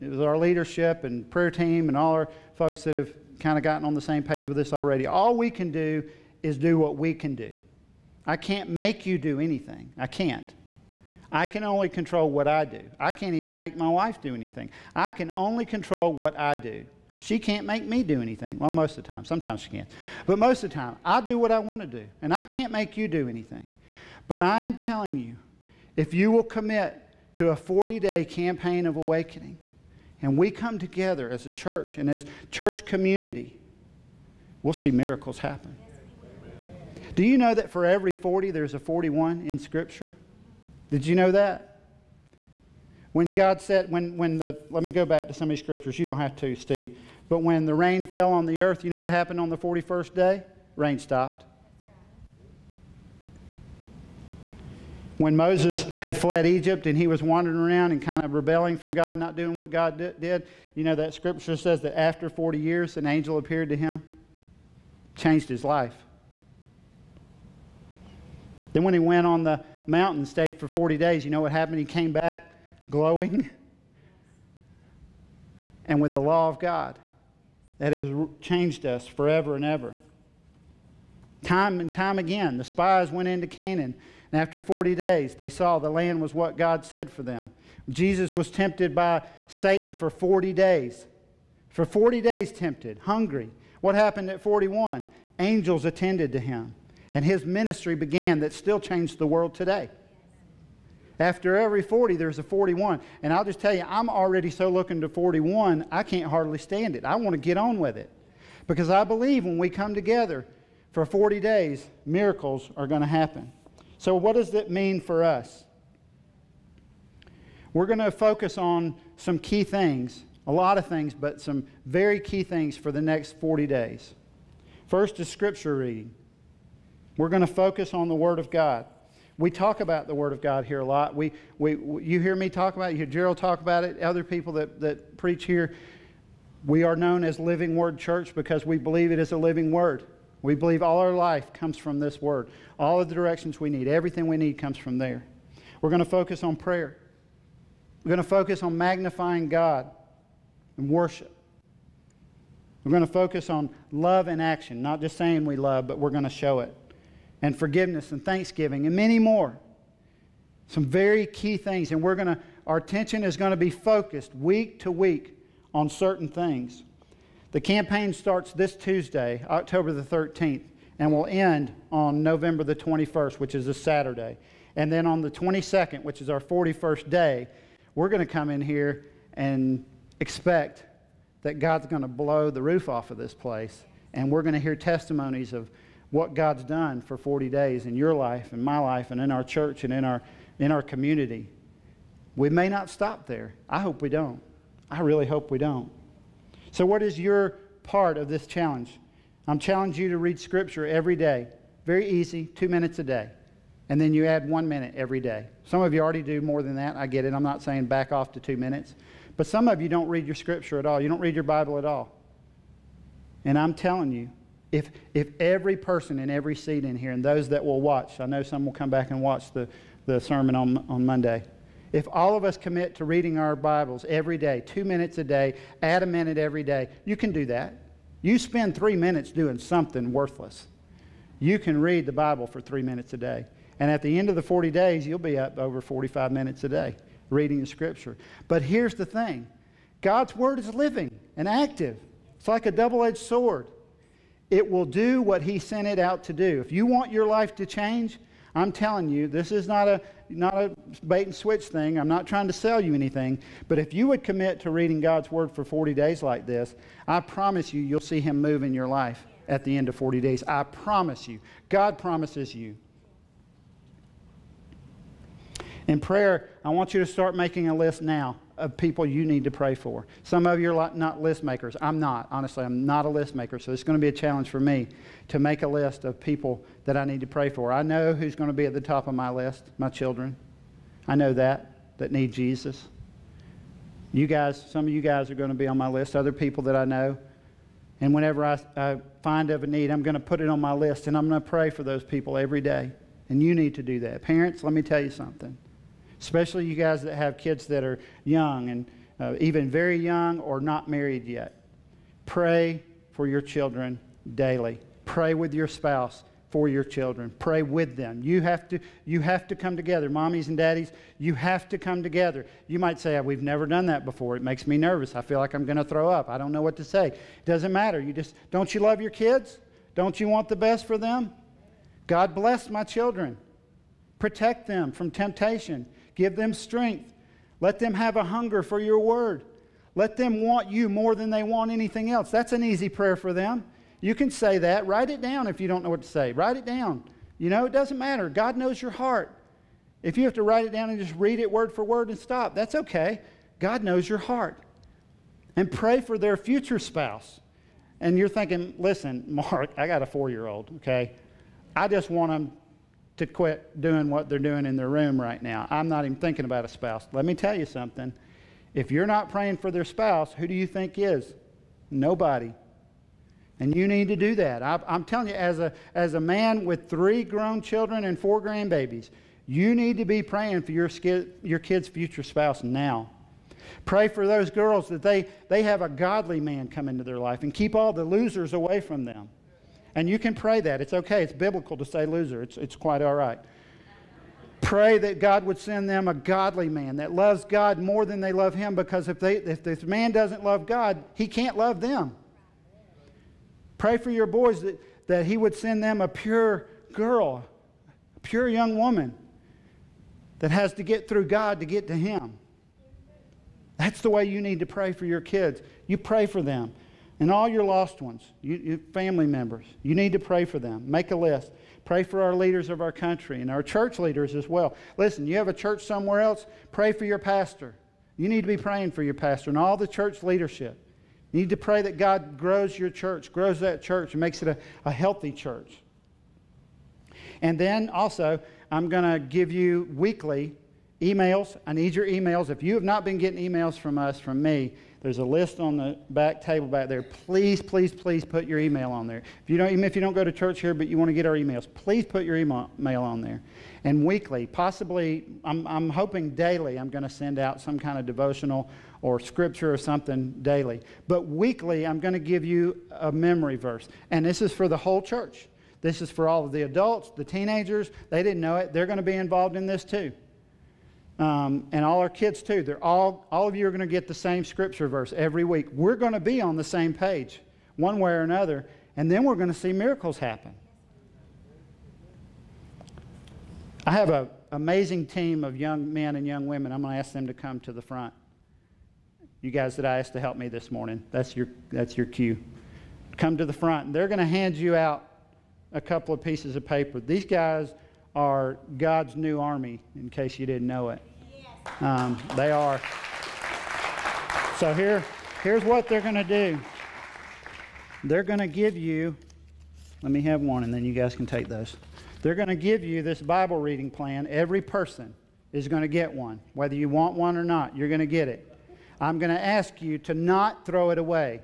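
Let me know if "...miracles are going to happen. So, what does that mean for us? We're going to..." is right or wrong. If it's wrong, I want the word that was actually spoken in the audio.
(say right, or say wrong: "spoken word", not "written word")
right.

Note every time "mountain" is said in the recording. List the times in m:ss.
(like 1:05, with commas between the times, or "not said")
1:09.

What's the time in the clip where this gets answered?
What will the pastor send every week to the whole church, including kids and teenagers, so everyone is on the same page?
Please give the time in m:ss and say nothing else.
7:33.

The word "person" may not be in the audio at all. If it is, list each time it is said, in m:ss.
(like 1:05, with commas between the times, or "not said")
3:35, 8:24.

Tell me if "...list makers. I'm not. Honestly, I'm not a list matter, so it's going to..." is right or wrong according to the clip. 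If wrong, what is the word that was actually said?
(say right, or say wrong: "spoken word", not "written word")
wrong: "maker", not "matter".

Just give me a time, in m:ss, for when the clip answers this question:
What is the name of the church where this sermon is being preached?
2:17.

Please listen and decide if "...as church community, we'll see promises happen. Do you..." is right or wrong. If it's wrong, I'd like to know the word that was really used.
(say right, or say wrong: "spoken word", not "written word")
wrong: "miracles", not "promises".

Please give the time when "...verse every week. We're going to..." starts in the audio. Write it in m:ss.
7:44.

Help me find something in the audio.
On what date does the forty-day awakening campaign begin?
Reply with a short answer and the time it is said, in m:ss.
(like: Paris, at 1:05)
October 13th, at 2:49.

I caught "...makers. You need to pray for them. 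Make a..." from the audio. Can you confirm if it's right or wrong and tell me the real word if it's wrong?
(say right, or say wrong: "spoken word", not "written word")
wrong: "members", not "makers".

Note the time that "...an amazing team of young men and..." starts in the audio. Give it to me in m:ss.
7:54.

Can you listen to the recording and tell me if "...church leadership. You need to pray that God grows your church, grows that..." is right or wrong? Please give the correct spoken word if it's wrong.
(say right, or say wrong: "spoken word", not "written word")
right.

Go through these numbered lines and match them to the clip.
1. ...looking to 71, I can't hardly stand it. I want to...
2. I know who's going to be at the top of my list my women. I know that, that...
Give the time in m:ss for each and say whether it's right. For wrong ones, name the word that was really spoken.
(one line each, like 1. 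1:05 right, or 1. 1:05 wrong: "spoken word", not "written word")
1. 1:44 wrong: "41", not "71"
2. 4:37 wrong: "children", not "women".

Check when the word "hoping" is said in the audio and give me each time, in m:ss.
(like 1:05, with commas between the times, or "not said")
7:25.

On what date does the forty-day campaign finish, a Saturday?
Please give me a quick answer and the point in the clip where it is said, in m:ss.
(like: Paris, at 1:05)
November 21st, at 2:52.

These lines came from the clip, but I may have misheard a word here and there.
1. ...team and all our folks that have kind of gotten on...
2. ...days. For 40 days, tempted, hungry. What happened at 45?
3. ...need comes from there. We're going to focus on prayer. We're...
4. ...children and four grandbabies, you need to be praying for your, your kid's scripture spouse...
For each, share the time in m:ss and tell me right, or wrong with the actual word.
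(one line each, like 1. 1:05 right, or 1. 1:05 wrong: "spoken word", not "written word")
1. 0:01 right
2. 1:30 wrong: "41", not "45"
3. 2:24 right
4. 6:07 wrong: "future", not "scripture".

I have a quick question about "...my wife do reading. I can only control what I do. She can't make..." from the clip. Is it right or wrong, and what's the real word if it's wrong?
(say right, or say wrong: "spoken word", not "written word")
wrong: "anything", not "reading".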